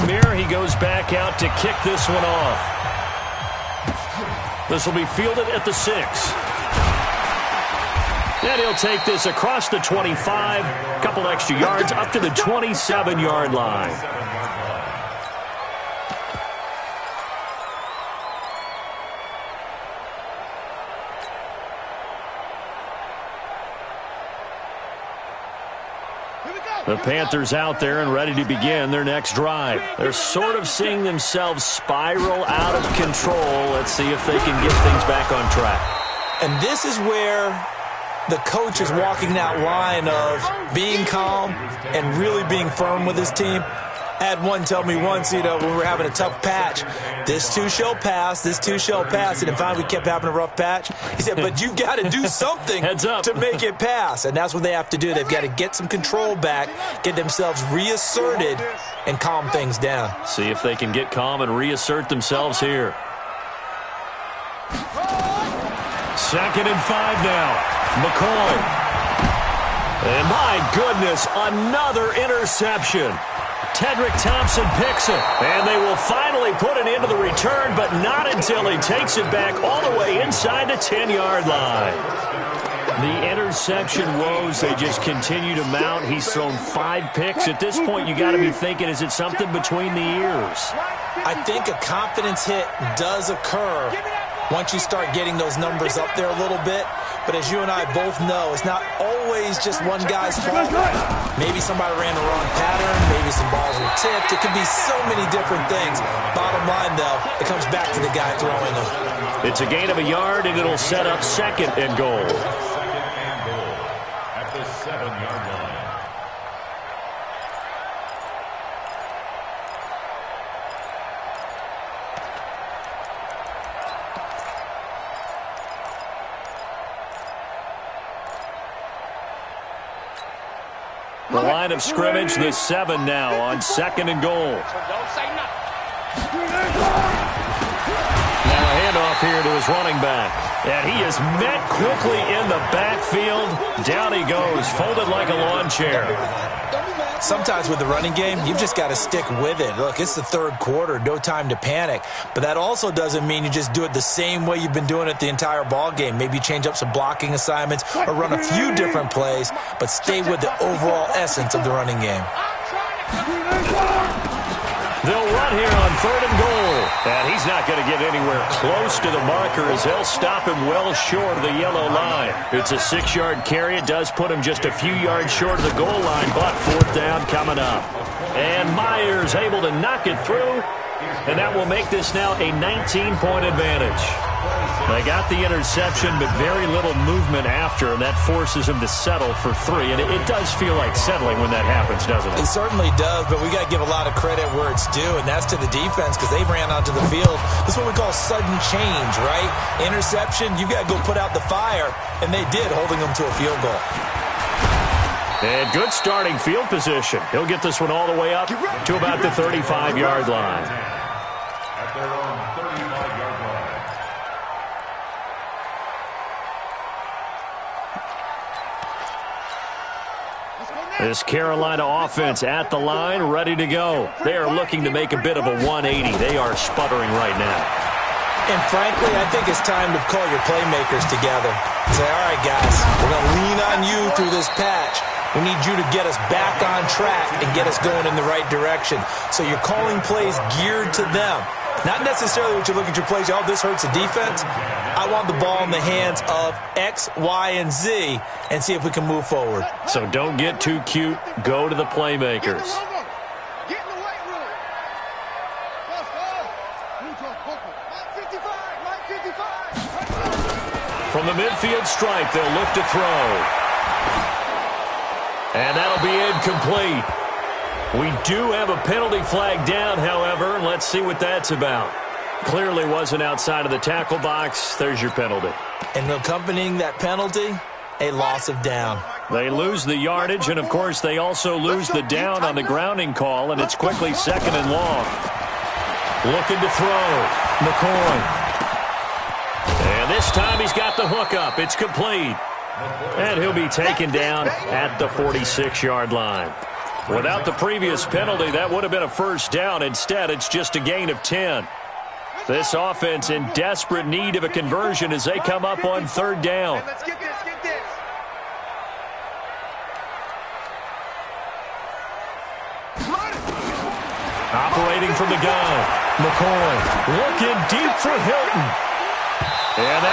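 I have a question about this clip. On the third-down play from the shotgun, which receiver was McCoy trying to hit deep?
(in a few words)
Hilton.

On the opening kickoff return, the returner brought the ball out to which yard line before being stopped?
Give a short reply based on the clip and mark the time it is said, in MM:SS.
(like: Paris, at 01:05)
27, at 00:12.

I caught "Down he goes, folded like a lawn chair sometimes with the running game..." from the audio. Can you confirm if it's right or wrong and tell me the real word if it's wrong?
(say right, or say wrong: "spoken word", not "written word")
right.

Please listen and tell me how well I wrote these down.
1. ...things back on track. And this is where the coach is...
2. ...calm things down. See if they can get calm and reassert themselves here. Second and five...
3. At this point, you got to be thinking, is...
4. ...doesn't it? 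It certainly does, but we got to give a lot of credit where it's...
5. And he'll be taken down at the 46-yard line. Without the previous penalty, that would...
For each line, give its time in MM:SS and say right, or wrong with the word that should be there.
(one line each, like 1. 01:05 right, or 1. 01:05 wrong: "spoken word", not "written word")
1. 00:34 right
2. 00:59 right
3. 01:27 right
4. 03:12 right
5. 04:53 right.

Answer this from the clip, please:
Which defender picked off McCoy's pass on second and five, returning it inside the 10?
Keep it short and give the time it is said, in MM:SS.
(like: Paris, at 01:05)
Tedric Thompson, at 01:13.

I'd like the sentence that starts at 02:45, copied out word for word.
They'll run here on third and goal.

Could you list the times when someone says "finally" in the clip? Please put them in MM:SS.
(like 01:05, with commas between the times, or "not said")
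00:49, 01:15.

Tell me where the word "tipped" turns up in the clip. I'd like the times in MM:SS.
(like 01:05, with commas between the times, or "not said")
01:43.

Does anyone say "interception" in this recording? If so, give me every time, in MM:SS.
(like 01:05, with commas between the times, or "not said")
01:12, 01:23, 03:05, 03:19.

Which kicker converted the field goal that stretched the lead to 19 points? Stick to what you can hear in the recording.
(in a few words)
Myers.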